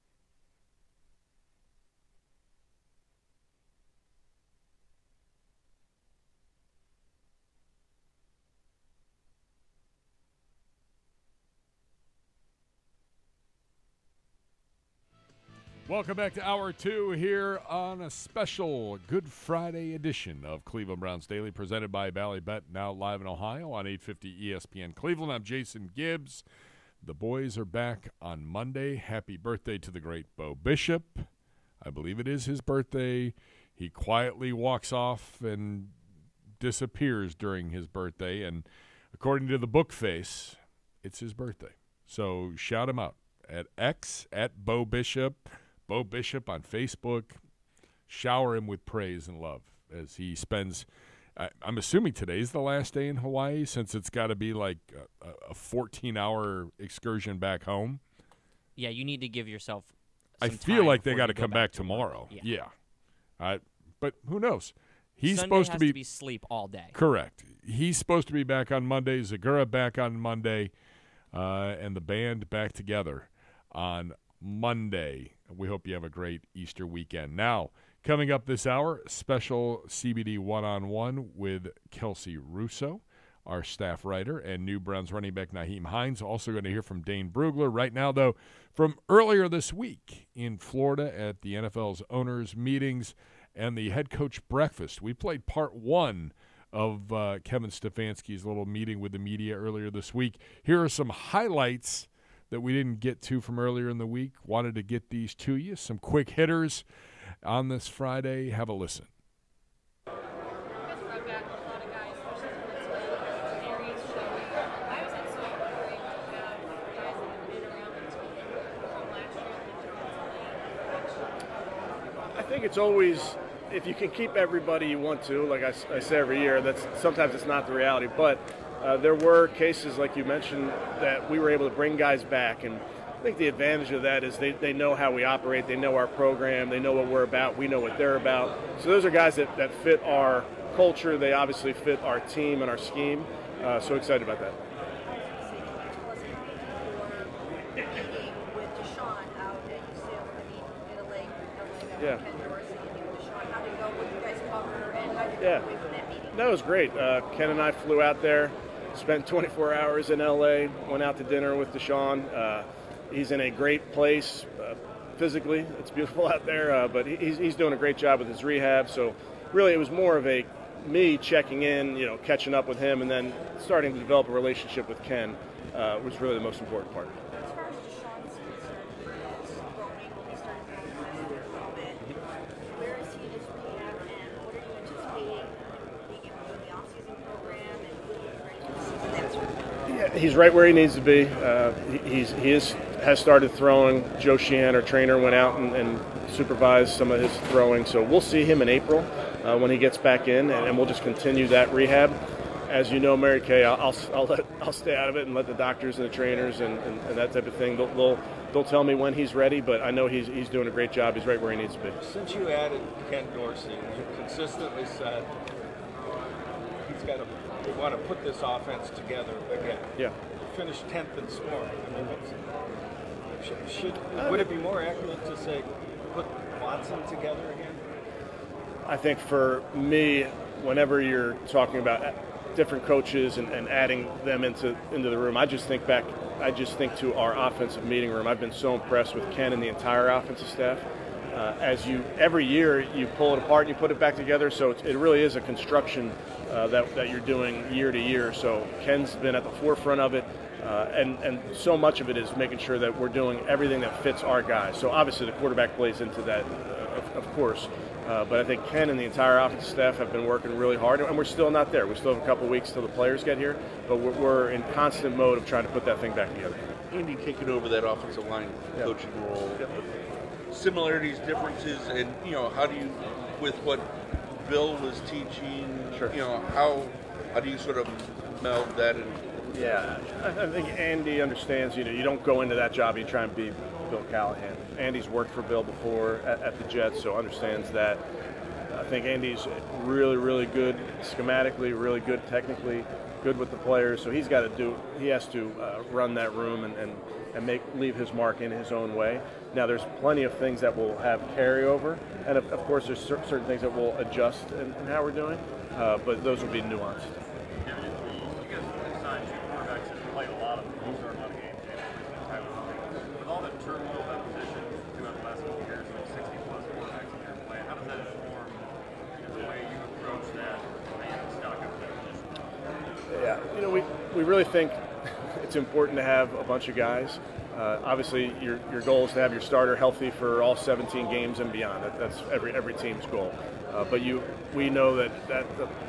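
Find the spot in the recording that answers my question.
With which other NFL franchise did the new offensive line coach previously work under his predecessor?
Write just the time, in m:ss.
4:46.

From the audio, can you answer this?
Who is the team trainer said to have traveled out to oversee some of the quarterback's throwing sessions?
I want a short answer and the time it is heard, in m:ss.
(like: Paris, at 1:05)
Joe Sheehan, at 3:14.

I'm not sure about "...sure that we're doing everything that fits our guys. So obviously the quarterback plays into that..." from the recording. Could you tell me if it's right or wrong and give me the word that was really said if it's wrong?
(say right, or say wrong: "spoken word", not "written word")
right.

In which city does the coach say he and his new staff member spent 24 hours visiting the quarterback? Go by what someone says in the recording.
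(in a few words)
LA.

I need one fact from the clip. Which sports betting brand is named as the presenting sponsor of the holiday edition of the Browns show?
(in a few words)
Bally Bet.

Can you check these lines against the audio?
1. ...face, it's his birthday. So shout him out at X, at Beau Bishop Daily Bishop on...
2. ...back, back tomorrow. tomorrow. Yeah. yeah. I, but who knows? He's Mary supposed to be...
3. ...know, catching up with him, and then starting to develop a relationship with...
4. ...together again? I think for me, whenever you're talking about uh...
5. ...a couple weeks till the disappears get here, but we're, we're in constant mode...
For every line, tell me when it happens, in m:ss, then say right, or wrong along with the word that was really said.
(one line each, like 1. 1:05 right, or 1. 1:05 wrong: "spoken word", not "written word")
1. 0:39 wrong: "Beau", not "Daily"
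2. 1:01 wrong: "Sunday", not "Mary"
3. 2:52 right
4. 3:47 right
5. 4:22 wrong: "players", not "disappears".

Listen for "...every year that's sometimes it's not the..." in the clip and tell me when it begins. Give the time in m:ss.
2:06.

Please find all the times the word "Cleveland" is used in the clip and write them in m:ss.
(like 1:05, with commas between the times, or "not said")
0:20, 0:24.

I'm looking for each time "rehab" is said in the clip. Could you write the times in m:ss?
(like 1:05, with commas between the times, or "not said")
2:48, 3:21.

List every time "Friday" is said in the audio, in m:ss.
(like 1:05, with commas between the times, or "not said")
0:19, 1:47.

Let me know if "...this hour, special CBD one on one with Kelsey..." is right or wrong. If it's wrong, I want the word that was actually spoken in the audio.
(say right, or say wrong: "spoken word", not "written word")
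right.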